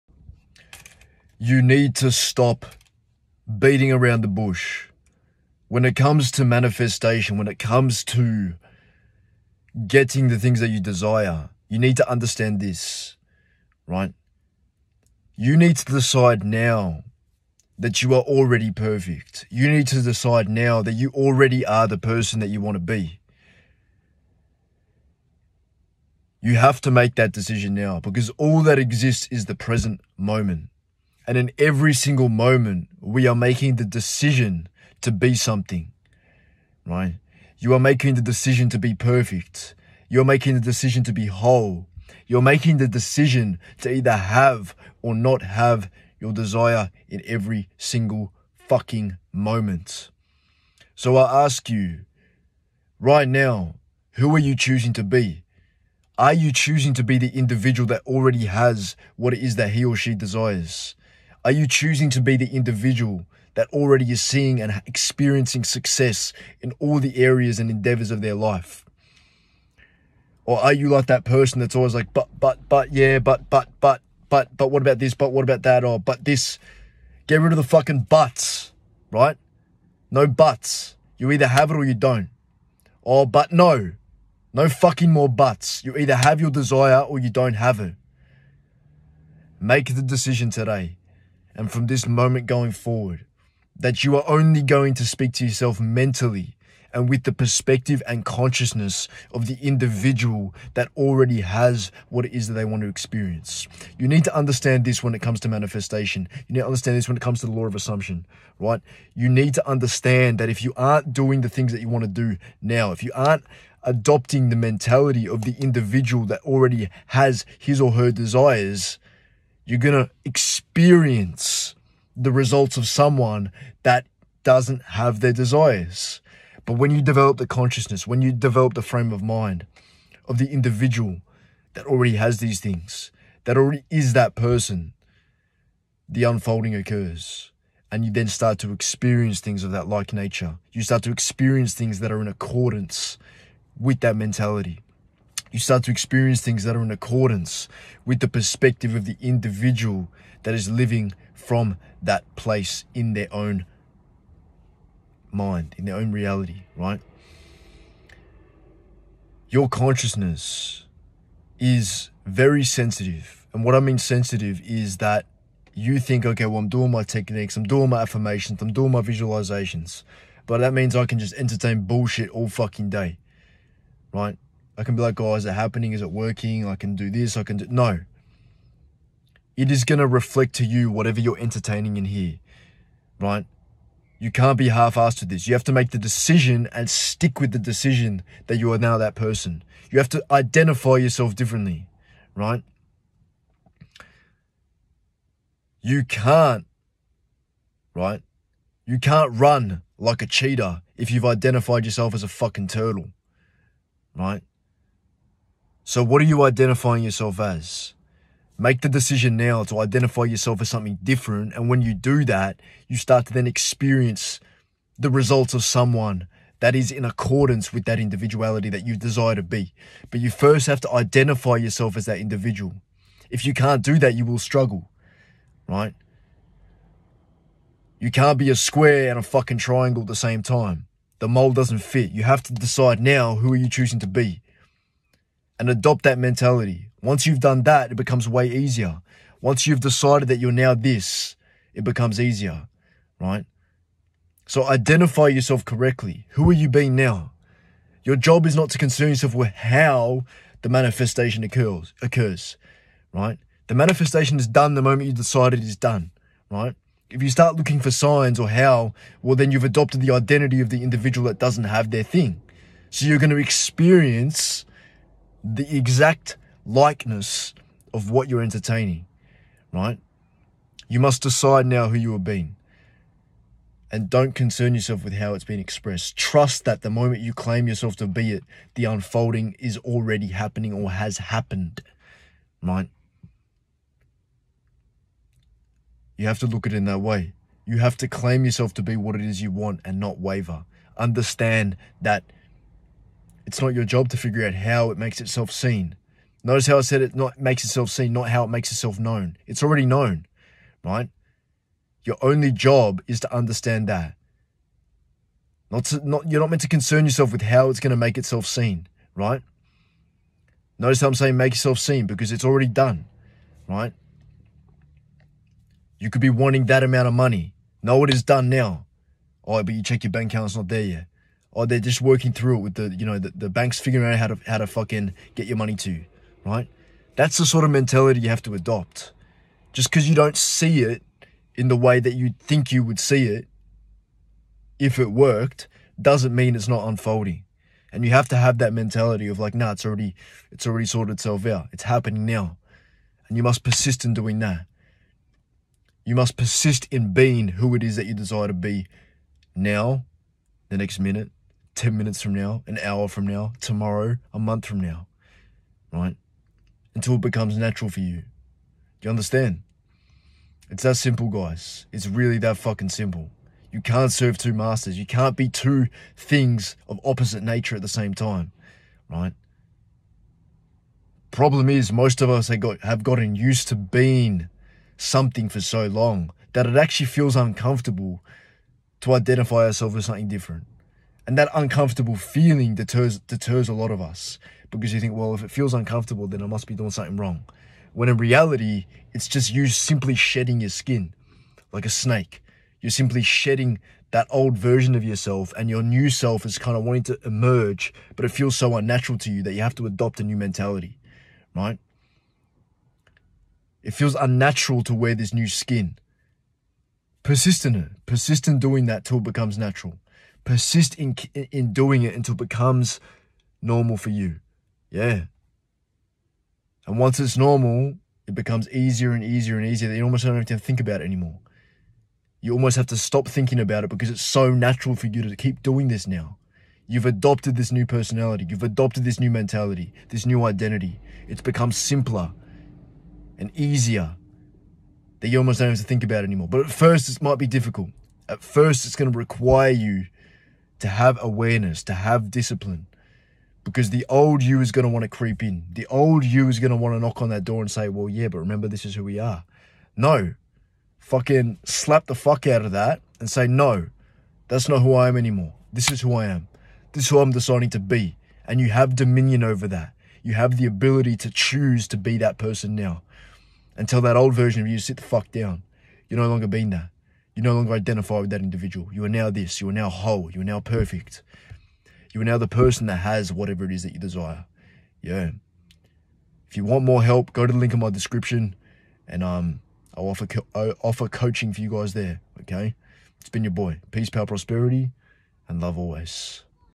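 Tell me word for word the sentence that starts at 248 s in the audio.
Your job is not to concern yourself with how the manifestation occurs, occurs, right?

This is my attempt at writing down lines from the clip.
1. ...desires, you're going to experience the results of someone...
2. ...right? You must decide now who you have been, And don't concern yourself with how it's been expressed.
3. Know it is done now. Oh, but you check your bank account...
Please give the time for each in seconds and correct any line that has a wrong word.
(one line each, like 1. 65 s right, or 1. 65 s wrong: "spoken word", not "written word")
1. 118 s right
2. 269 s right
3. 317 s right.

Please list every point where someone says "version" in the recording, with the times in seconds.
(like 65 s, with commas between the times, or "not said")
394 s, 464 s.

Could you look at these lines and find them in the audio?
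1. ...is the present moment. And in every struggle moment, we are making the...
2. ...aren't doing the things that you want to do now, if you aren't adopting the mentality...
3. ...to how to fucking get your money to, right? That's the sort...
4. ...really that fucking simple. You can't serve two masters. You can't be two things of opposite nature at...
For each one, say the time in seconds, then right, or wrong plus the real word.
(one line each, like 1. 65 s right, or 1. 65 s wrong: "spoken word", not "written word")
1. 29 s wrong: "single", not "struggle"
2. 110 s right
3. 324 s right
4. 362 s right.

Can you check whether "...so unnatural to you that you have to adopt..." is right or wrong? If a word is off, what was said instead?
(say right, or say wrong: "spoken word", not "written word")
right.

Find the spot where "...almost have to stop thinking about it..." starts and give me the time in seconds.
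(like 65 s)
422 s.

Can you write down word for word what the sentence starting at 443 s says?
Because the old you is going to want to creep in.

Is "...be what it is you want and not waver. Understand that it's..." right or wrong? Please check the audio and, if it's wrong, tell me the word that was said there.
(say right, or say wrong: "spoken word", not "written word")
right.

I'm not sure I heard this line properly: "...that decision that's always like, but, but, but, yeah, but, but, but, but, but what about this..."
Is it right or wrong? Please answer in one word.
wrong.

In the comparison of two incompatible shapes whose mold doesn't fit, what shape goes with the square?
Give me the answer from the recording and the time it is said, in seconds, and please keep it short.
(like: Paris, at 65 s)
triangle, at 229 s.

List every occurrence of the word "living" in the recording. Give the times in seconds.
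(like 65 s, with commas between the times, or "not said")
150 s.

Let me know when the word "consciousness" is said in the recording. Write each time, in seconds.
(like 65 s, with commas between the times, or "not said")
98 s, 127 s, 159 s.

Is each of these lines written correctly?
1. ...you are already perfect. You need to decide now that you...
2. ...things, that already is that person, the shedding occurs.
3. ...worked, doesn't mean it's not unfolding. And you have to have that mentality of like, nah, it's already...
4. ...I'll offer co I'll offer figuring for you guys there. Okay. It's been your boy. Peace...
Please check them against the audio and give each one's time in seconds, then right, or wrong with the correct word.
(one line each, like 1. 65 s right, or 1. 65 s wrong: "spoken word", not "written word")
1. 18 s right
2. 132 s wrong: "unfolding", not "shedding"
3. 335 s right
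4. 479 s wrong: "coaching", not "figuring".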